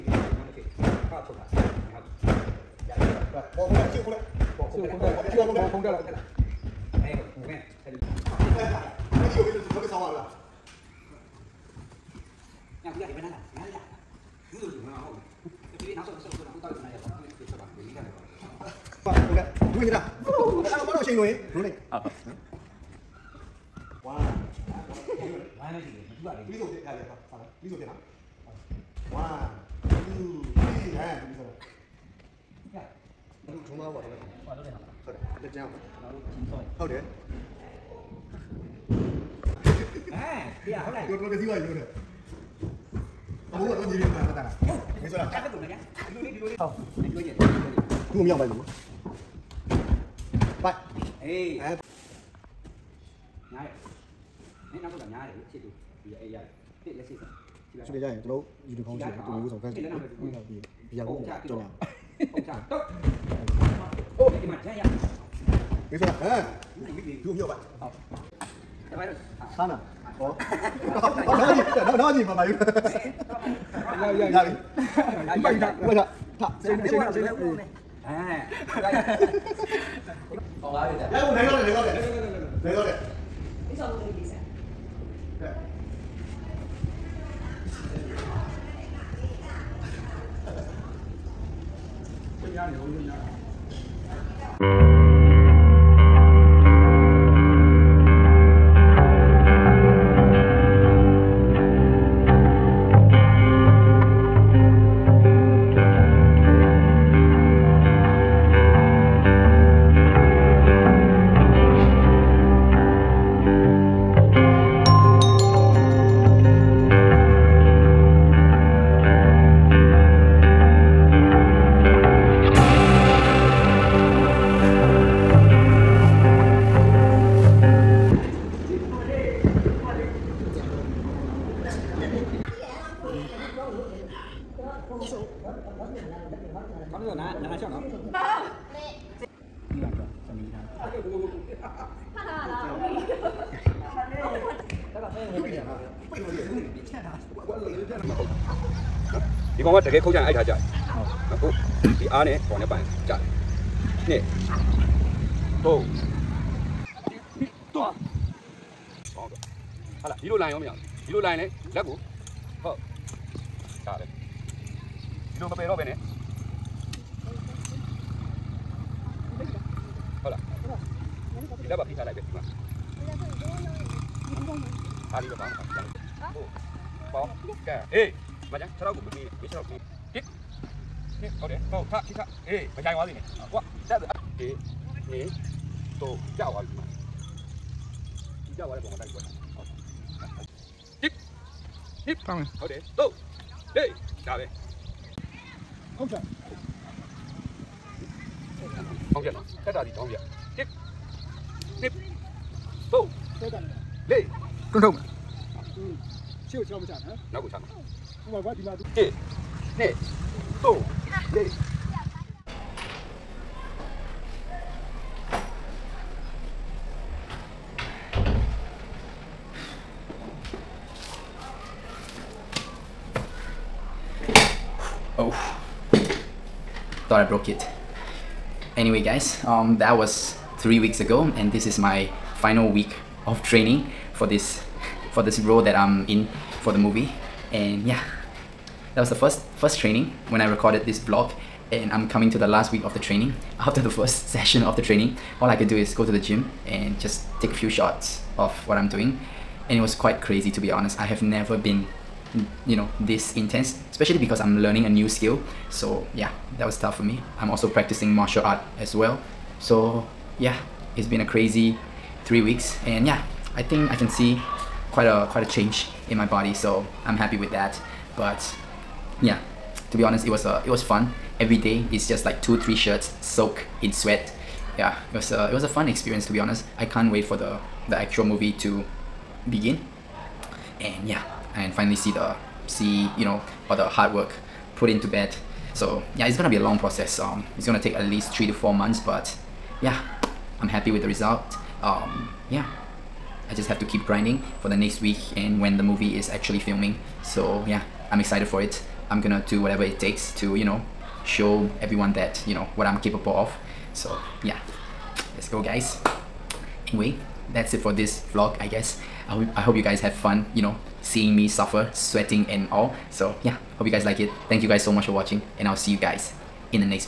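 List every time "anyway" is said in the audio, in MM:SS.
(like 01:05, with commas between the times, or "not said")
03:48, 05:06.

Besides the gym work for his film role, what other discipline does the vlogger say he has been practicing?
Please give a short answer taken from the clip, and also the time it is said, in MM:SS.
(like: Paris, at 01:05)
Martial art, at 04:18.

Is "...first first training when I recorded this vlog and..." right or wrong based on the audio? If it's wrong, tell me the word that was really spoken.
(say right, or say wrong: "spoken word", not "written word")
right.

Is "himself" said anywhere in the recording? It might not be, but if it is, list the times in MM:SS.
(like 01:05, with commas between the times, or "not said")
not said.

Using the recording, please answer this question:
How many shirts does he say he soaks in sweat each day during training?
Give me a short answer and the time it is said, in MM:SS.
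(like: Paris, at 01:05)
2 to 3, at 04:32.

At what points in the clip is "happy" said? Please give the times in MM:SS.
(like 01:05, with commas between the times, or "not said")
04:27, 04:50.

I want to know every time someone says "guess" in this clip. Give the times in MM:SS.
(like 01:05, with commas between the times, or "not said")
05:08.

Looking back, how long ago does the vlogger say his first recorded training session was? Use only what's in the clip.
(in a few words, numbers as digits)
3 weeks.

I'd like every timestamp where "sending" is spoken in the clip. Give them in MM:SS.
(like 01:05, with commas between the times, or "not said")
not said.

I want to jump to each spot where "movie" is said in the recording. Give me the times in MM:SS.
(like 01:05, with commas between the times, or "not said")
03:56, 04:38, 04:55.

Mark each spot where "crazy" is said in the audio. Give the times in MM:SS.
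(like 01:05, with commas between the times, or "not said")
04:10, 04:21.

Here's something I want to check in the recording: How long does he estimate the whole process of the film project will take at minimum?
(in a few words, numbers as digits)
3 to 4 months.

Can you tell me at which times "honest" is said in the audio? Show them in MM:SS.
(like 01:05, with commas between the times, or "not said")
04:10, 04:30, 04:36.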